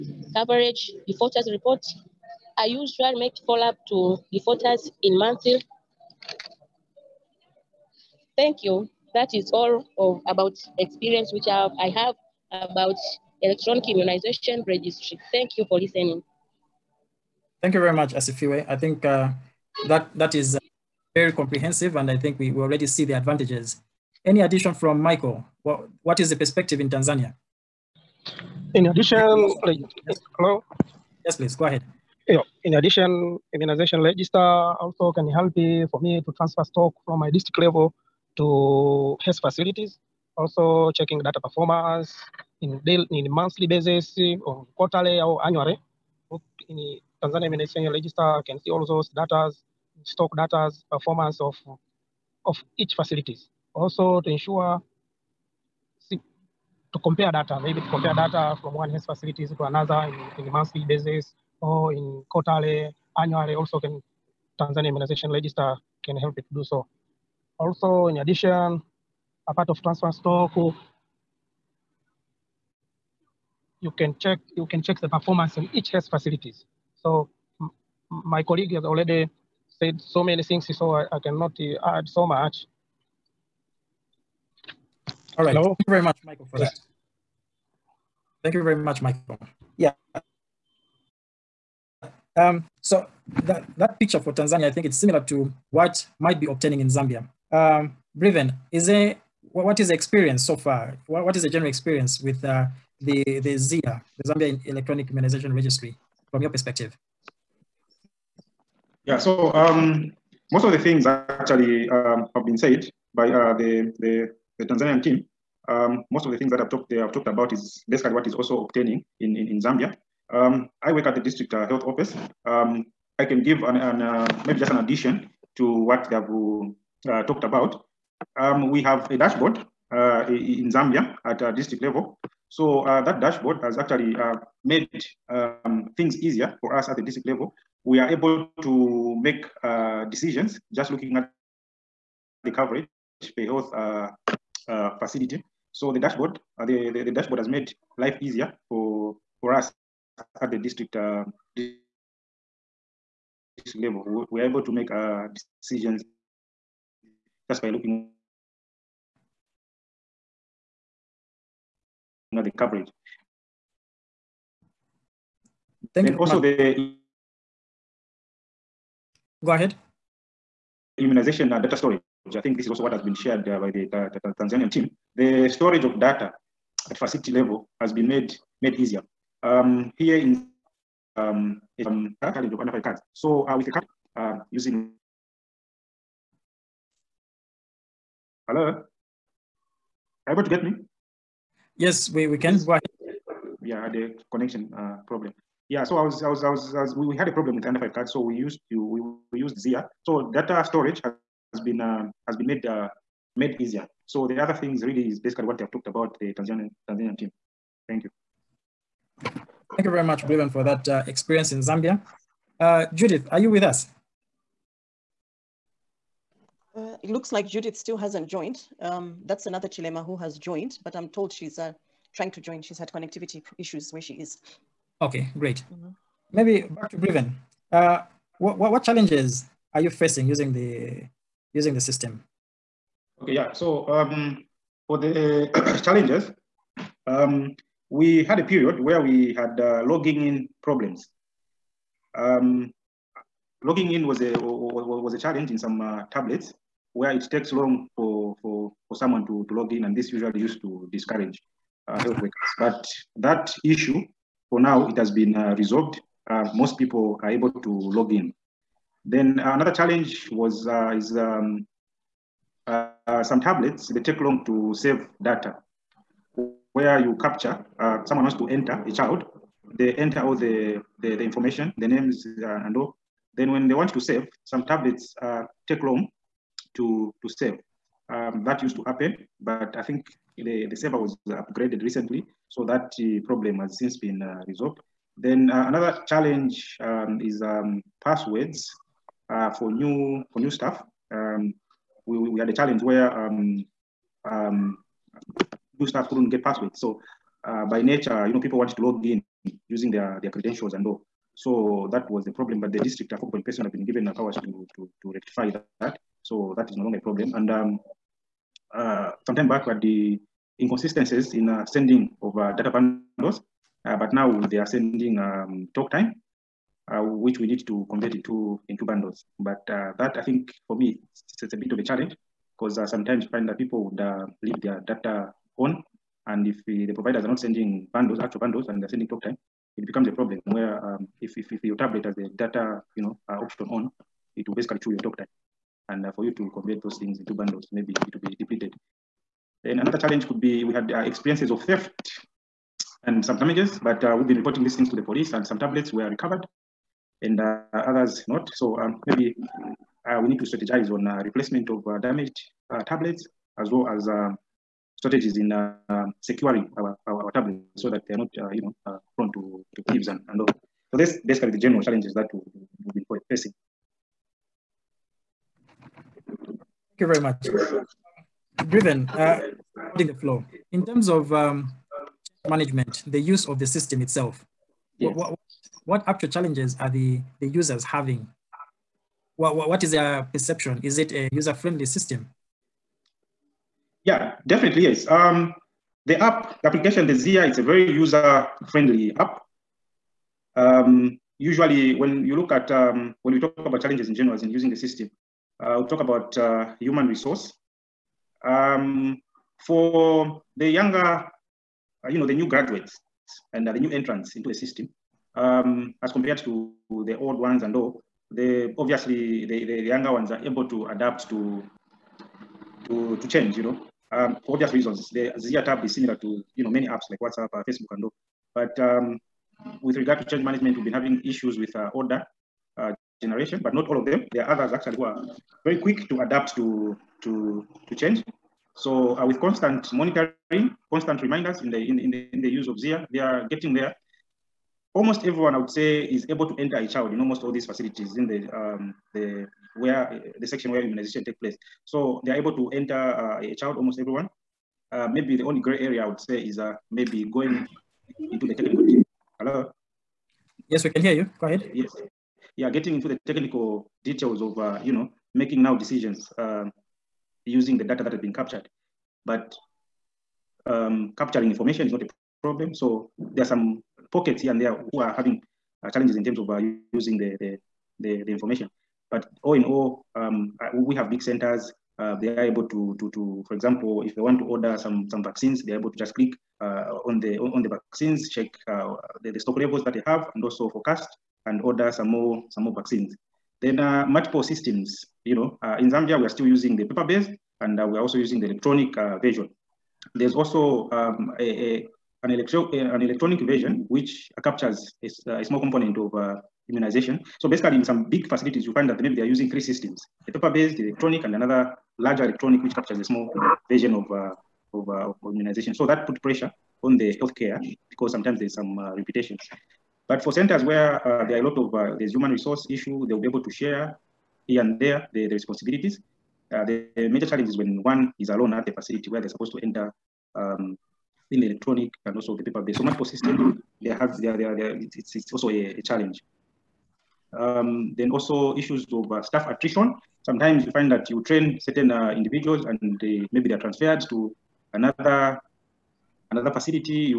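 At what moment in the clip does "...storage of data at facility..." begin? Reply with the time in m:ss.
2:55.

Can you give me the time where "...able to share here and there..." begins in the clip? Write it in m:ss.
8:33.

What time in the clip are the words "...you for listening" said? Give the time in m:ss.
0:15.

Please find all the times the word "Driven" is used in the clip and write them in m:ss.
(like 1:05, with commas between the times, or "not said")
6:08.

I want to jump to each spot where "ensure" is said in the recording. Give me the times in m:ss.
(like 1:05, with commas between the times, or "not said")
0:54.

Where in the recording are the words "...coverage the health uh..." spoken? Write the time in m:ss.
2:22.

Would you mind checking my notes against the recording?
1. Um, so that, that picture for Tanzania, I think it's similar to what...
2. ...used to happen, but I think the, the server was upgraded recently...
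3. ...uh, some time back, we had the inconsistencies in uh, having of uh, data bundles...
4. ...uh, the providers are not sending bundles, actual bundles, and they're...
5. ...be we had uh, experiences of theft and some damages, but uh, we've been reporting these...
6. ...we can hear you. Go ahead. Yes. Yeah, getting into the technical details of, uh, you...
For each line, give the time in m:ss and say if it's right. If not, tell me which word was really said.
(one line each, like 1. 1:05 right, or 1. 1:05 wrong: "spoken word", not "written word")
1. 1:32 right
2. 4:38 right
3. 5:08 wrong: "sending", not "having"
4. 5:26 right
5. 5:40 right
6. 7:30 right.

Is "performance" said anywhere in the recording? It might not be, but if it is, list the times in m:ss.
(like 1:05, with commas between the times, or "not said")
0:41, 0:50, 1:15.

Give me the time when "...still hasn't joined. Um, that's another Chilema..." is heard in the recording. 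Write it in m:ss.
3:37.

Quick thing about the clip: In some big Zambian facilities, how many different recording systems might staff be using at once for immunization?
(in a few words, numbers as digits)
3.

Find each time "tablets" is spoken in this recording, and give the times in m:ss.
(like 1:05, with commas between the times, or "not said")
4:06, 4:23, 4:34, 5:31, 5:45, 5:52, 5:57.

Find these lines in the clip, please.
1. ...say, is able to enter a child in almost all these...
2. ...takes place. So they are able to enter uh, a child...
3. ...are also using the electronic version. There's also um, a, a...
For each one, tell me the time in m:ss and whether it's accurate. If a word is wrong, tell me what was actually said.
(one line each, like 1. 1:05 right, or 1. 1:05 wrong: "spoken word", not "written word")
1. 7:15 right
2. 7:21 right
3. 8:07 right.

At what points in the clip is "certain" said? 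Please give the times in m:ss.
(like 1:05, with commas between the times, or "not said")
8:51.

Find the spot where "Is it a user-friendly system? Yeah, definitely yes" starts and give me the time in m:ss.
6:20.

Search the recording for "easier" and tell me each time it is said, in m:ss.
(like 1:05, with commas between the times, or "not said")
2:16, 2:28, 2:58, 3:23.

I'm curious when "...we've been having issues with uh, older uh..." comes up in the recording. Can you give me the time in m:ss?
7:00.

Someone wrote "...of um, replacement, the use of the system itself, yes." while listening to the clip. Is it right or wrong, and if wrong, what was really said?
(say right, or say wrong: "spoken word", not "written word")
wrong: "management", not "replacement".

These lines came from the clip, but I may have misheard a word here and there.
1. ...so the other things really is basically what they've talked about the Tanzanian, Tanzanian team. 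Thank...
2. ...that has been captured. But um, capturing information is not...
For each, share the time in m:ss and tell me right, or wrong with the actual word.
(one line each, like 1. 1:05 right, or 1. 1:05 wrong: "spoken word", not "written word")
1. 3:24 right
2. 7:38 right.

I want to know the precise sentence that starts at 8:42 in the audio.
So multiple systems, they have, they are, they are, they are it's, it's also a, a challenge.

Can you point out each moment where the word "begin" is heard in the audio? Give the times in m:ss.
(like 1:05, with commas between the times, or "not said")
not said.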